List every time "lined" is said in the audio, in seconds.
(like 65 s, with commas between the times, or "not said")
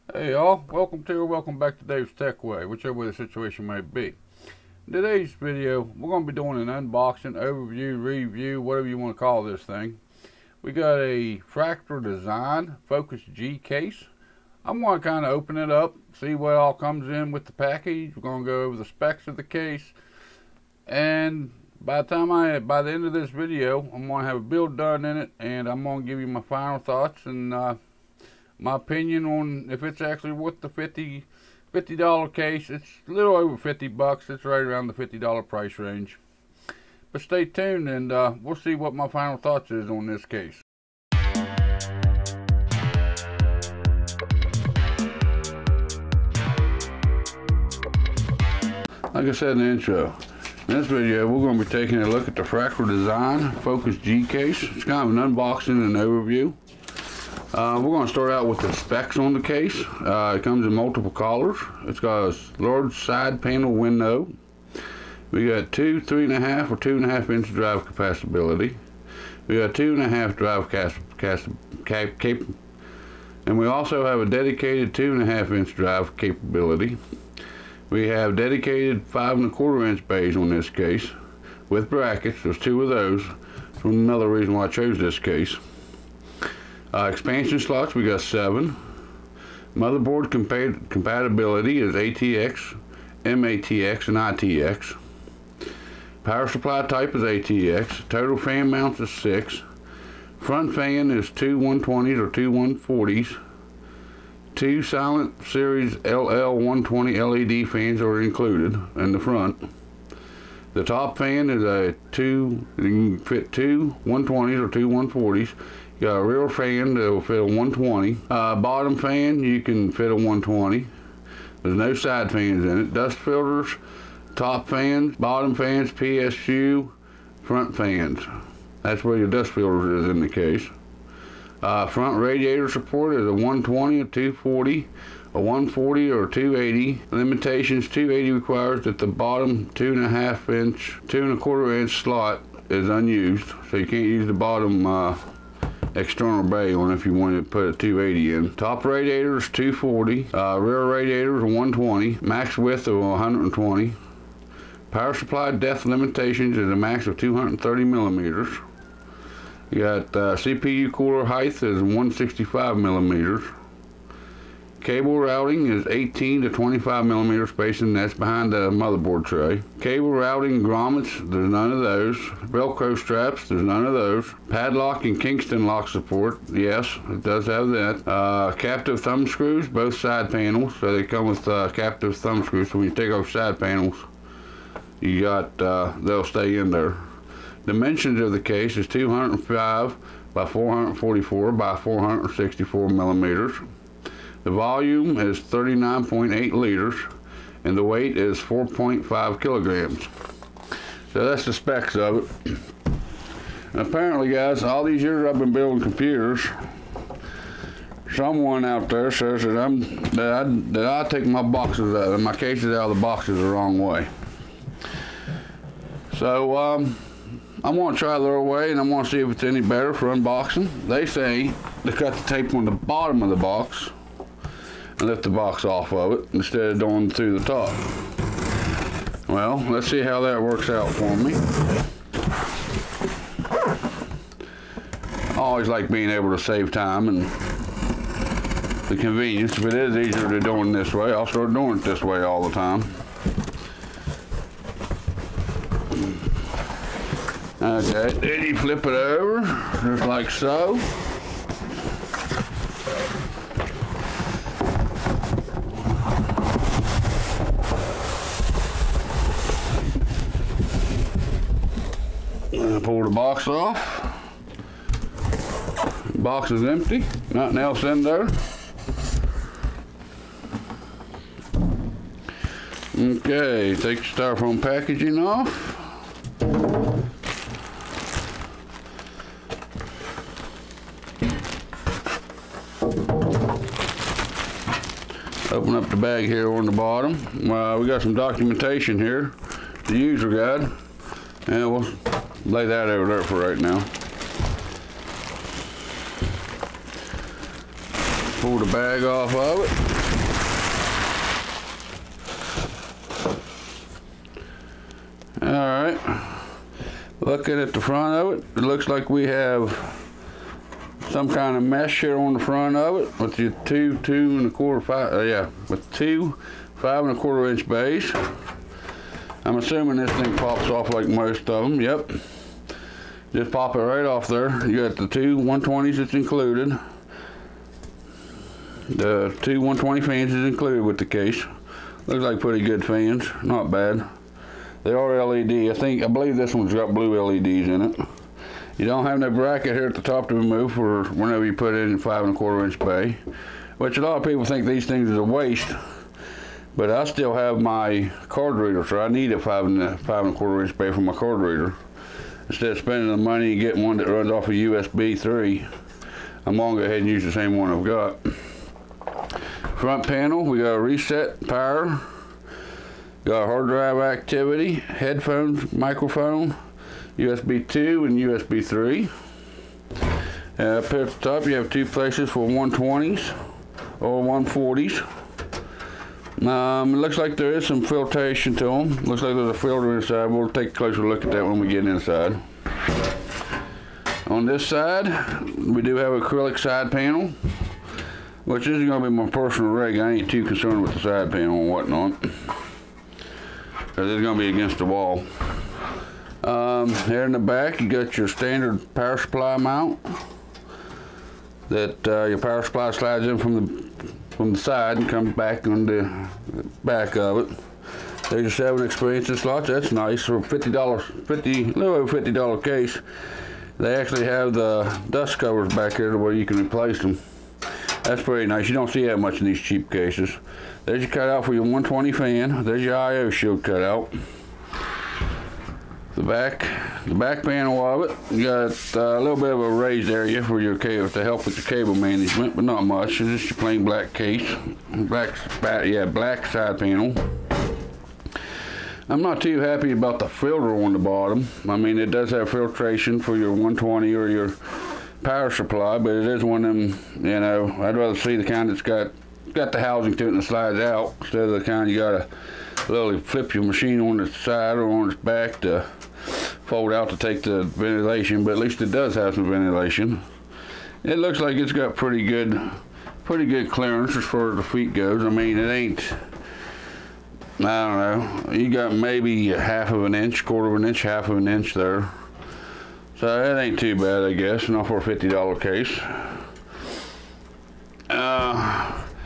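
not said.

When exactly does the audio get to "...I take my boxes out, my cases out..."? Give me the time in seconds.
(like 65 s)
210 s.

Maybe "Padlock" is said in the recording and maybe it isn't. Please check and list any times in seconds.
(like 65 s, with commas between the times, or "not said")
174 s.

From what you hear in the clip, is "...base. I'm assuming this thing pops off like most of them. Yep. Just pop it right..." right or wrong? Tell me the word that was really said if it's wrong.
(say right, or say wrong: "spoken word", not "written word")
right.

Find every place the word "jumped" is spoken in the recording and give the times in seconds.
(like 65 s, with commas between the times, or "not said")
not said.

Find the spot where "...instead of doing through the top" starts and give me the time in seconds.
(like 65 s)
226 s.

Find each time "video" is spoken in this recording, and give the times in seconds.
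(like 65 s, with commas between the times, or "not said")
5 s, 23 s, 50 s.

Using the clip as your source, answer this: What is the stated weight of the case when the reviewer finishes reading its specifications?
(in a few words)
4.5 kilograms.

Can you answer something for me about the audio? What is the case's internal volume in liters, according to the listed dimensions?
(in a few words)
39.8 liters.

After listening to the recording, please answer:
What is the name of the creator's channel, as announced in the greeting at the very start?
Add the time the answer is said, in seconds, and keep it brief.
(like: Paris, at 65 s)
Dave's Tech Way, at 1 s.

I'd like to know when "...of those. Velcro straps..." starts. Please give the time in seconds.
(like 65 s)
171 s.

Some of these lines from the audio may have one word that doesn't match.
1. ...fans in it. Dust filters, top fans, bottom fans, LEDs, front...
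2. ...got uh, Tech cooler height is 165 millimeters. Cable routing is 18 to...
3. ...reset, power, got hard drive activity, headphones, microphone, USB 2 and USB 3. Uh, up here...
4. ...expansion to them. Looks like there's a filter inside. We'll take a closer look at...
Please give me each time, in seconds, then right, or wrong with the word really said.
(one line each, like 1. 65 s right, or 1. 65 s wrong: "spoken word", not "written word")
1. 122 s wrong: "PSU", not "LEDs"
2. 159 s wrong: "CPU", not "Tech"
3. 360 s right
4. 377 s wrong: "filtration", not "expansion".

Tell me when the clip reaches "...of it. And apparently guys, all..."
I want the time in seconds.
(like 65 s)
201 s.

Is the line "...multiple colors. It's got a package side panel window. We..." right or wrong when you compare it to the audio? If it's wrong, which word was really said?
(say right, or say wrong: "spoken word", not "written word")
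wrong: "large", not "package".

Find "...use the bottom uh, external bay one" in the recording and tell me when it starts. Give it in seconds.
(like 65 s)
144 s.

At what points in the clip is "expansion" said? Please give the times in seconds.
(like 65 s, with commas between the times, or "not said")
87 s, 408 s.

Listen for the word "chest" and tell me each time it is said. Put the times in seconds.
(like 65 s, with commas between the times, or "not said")
not said.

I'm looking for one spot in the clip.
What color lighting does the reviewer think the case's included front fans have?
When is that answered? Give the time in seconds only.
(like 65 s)
336 s.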